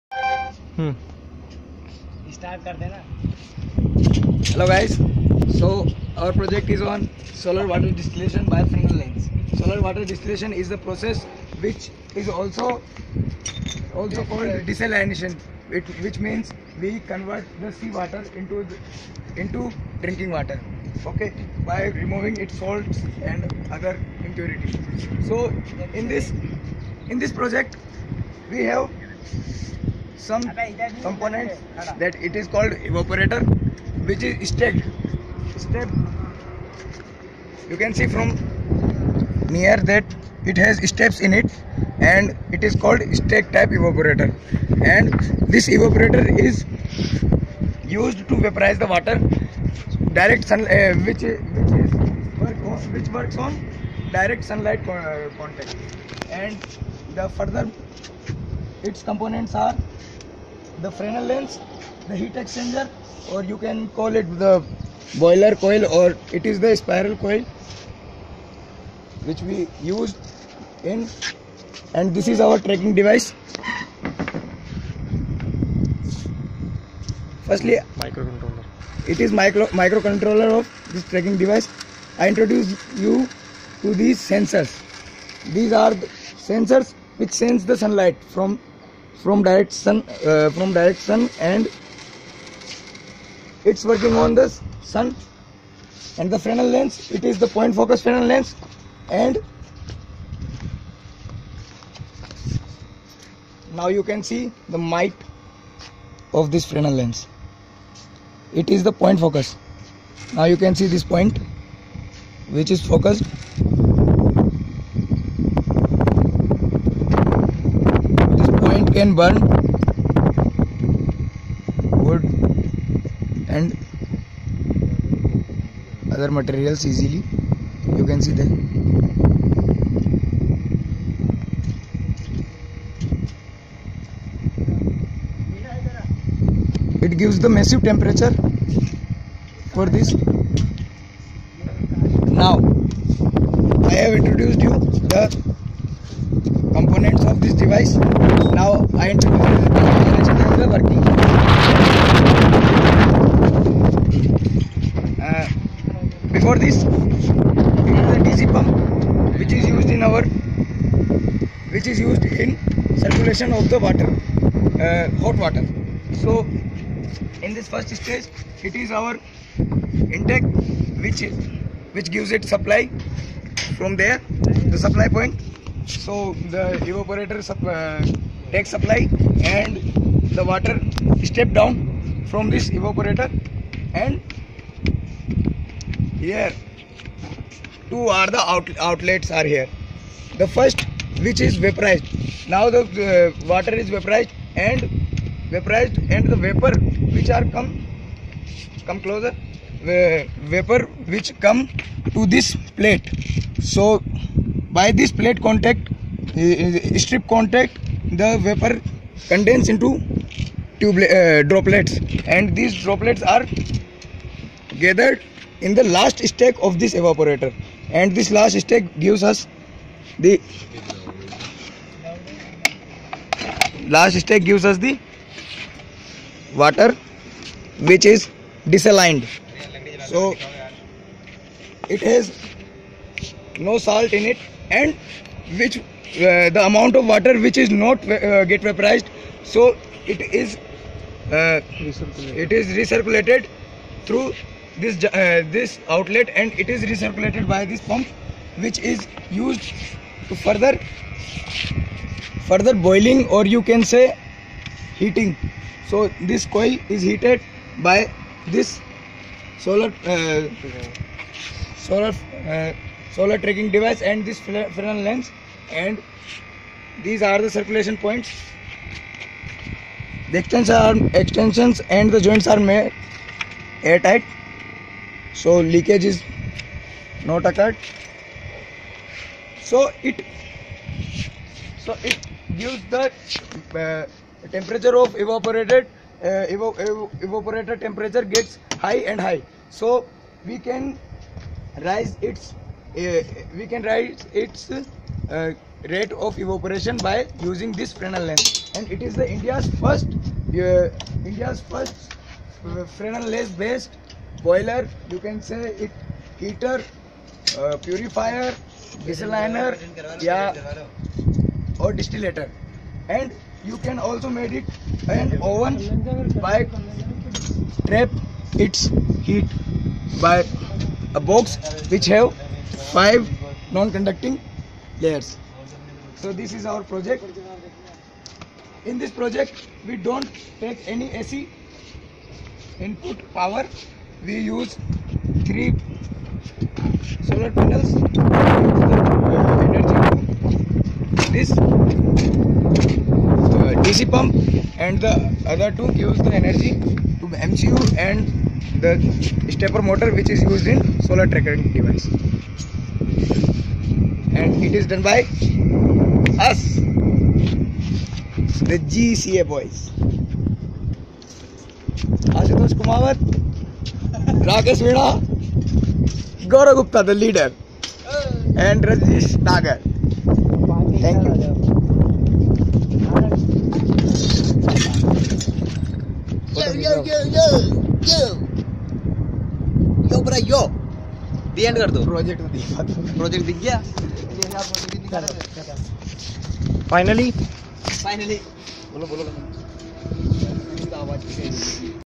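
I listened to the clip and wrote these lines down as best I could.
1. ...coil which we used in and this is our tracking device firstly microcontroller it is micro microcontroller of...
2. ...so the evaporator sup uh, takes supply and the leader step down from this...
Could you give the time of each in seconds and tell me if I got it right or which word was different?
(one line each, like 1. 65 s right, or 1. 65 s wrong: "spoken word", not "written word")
1. 67 s right
2. 175 s wrong: "water", not "leader".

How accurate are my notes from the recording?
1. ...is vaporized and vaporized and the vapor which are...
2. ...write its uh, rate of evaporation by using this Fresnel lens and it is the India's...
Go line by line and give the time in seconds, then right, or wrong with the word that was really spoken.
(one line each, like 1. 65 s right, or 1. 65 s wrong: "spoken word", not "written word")
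1. 193 s right
2. 293 s right.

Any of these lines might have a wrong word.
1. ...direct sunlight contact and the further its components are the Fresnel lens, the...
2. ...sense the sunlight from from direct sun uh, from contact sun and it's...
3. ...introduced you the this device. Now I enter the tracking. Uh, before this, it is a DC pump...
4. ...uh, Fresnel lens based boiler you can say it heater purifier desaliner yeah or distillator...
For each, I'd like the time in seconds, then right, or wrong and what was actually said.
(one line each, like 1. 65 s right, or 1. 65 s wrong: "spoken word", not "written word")
1. 54 s right
2. 87 s wrong: "direct", not "contact"
3. 144 s wrong: "working", not "tracking"
4. 302 s right.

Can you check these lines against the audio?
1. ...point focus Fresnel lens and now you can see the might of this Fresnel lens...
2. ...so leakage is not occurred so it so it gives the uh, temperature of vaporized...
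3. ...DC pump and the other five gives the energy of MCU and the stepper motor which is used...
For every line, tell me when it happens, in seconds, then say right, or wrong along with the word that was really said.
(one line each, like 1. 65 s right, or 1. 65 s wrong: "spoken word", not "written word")
1. 97 s right
2. 275 s wrong: "evaporated", not "vaporized"
3. 343 s wrong: "two", not "five".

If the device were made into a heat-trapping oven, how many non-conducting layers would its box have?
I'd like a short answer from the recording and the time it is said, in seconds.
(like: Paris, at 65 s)
5, at 322 s.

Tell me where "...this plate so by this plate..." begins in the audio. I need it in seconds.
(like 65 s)
202 s.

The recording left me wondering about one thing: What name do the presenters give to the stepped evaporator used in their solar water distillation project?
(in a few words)
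stack type evaporator.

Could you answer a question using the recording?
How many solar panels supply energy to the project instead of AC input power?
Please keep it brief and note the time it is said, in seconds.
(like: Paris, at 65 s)
3, at 335 s.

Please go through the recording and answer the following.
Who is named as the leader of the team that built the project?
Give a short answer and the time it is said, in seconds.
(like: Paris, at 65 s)
Gaurav Gupta, at 366 s.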